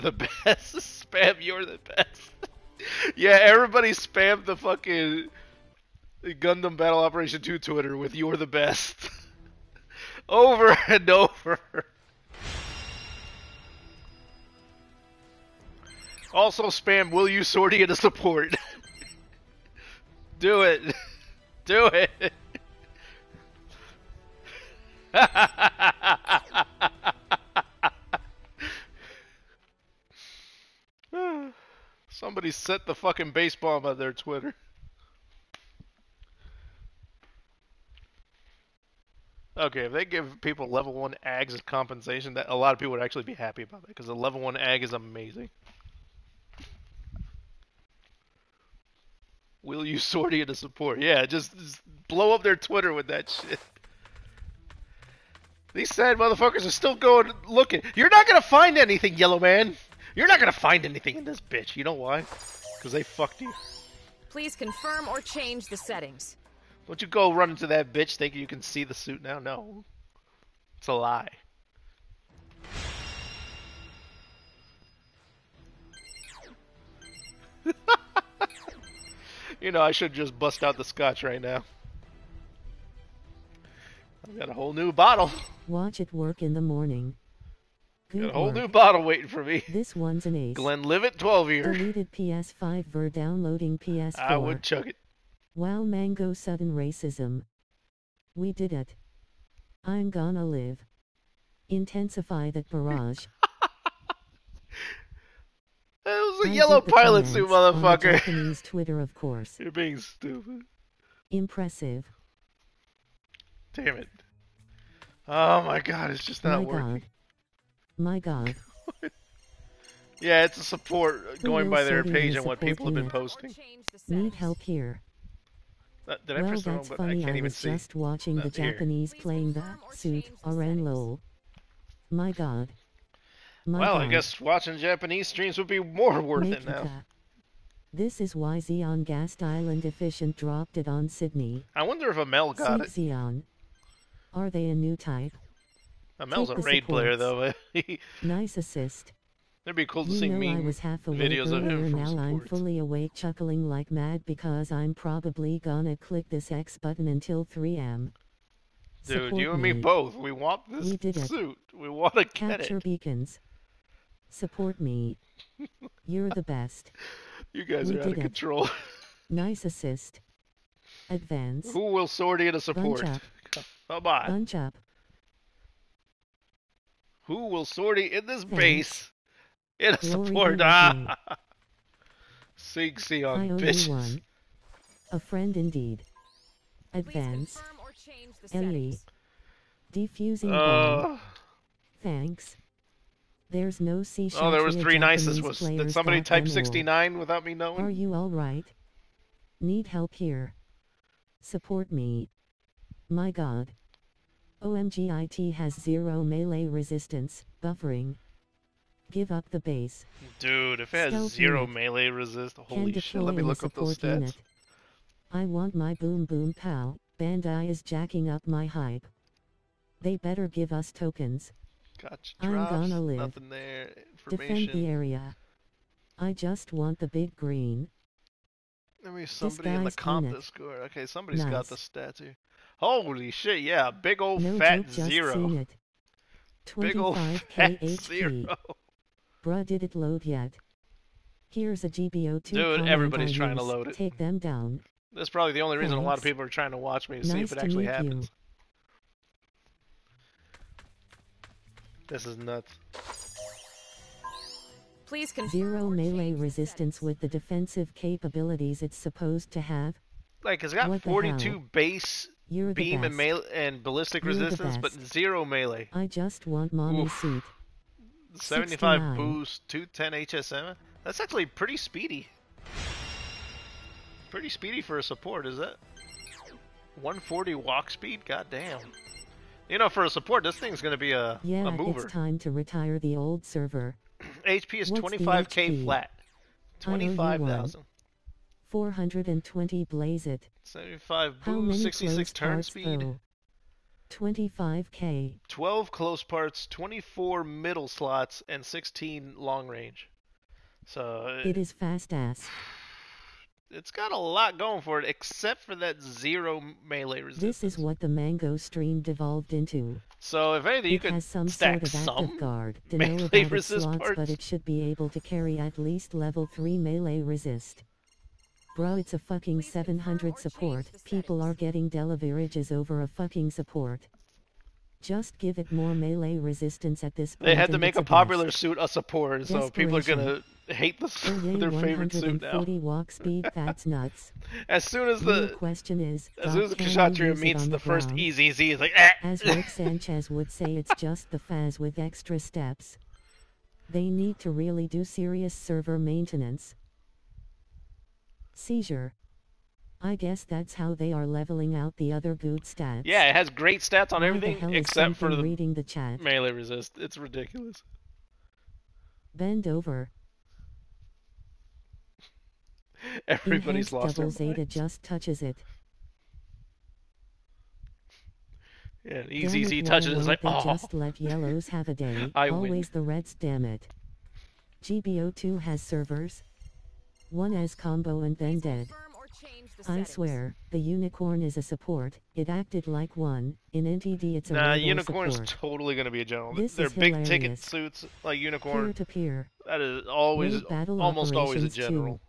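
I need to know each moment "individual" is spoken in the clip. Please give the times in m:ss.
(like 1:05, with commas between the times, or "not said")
not said.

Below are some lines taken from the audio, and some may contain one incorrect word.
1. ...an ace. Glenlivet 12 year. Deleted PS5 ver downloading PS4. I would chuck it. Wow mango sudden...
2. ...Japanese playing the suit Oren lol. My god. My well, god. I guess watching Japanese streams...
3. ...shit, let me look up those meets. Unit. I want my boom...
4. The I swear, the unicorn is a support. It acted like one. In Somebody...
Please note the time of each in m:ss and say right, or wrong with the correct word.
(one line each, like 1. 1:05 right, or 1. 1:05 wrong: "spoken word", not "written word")
1. 1:30 right
2. 2:08 right
3. 3:32 wrong: "stats", not "meets"
4. 6:19 wrong: "NTD", not "Somebody".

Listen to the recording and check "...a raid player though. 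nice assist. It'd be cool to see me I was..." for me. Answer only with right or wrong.
right.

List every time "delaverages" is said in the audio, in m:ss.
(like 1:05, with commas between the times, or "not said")
5:21.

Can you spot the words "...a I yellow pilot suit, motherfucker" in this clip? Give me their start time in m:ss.
1:46.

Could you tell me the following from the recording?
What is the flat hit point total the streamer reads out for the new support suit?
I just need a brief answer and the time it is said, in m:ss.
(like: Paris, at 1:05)
25,000, at 4:46.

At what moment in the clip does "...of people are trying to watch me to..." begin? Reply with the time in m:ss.
4:06.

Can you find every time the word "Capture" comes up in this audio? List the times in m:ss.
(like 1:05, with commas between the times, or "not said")
2:42.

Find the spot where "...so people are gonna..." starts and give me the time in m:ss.
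5:29.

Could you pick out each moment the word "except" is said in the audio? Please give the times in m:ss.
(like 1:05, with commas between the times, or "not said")
5:05, 5:54.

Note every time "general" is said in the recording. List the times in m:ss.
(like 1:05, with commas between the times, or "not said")
6:26, 6:31.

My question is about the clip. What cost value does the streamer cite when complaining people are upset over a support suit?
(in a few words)
700.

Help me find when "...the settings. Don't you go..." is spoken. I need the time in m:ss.
1:05.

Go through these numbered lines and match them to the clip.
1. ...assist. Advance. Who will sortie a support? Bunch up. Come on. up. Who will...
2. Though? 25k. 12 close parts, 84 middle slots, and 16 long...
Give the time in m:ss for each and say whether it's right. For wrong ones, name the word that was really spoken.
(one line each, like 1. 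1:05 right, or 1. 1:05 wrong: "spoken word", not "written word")
1. 2:49 right
2. 4:52 wrong: "24", not "84".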